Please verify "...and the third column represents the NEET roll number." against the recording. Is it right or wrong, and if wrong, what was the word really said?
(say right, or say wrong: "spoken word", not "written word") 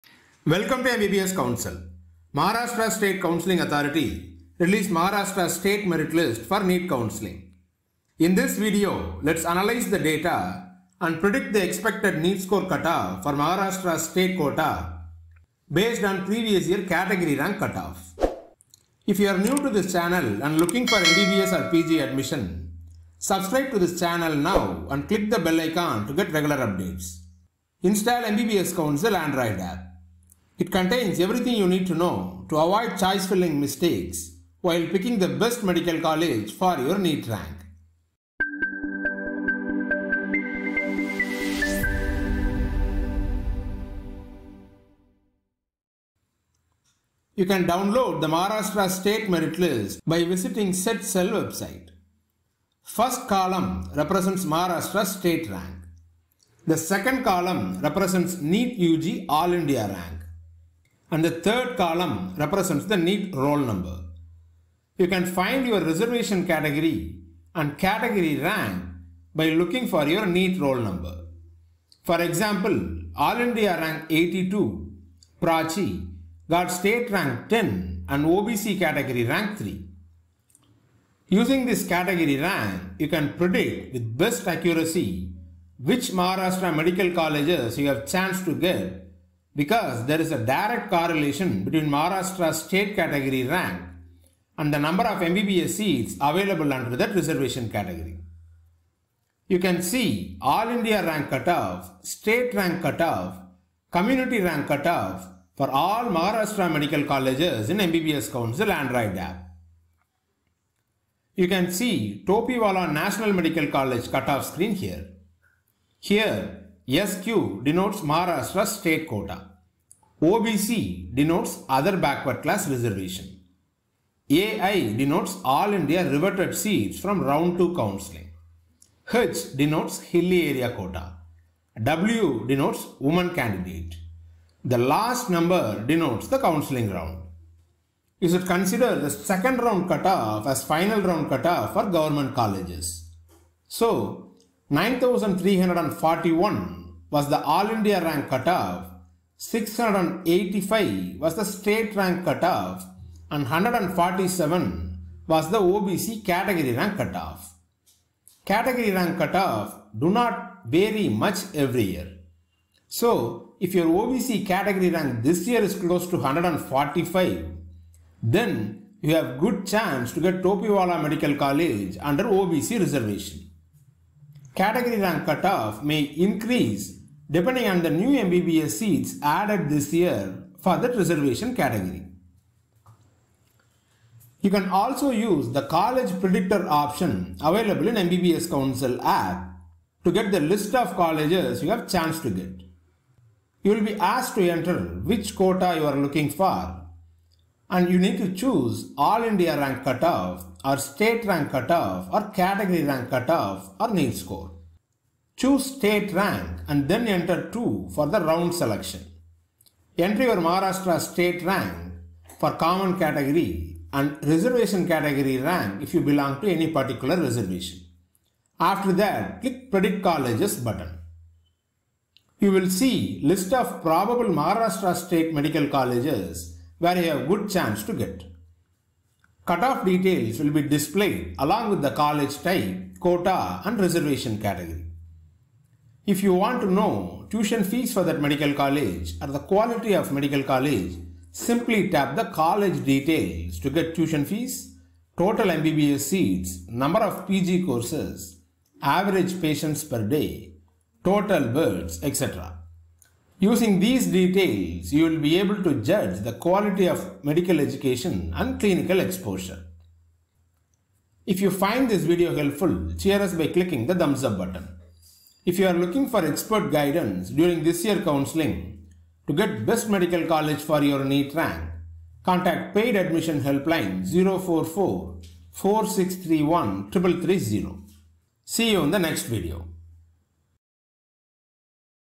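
right.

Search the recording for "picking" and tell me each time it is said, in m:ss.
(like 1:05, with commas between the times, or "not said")
0:34.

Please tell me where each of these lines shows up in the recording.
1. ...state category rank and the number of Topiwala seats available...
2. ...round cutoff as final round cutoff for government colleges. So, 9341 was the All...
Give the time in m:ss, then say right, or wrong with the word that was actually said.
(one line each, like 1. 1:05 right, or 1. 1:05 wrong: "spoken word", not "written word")
1. 1:32 wrong: "MBBS", not "Topiwala"
2. 2:19 right.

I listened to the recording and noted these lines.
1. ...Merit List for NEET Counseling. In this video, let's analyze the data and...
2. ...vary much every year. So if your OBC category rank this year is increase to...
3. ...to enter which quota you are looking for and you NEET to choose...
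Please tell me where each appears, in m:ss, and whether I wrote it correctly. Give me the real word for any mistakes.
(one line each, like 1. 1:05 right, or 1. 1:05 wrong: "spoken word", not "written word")
1. 0:05 right
2. 2:40 wrong: "close", not "increase"
3. 3:14 right.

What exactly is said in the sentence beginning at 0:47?
You can download the Maharashtra State Merit List by visiting CET Cell website.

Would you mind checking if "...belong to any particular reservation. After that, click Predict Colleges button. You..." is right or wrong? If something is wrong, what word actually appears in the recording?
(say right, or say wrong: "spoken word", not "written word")
right.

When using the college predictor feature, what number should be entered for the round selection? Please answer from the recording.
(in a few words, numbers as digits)
2.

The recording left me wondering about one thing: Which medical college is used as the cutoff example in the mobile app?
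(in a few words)
Topiwala National Medical College.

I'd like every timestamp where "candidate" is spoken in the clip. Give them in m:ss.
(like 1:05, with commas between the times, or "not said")
2:13.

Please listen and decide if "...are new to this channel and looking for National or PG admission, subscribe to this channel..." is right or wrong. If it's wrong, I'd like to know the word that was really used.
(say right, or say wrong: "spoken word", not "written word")
wrong: "MBBS", not "National".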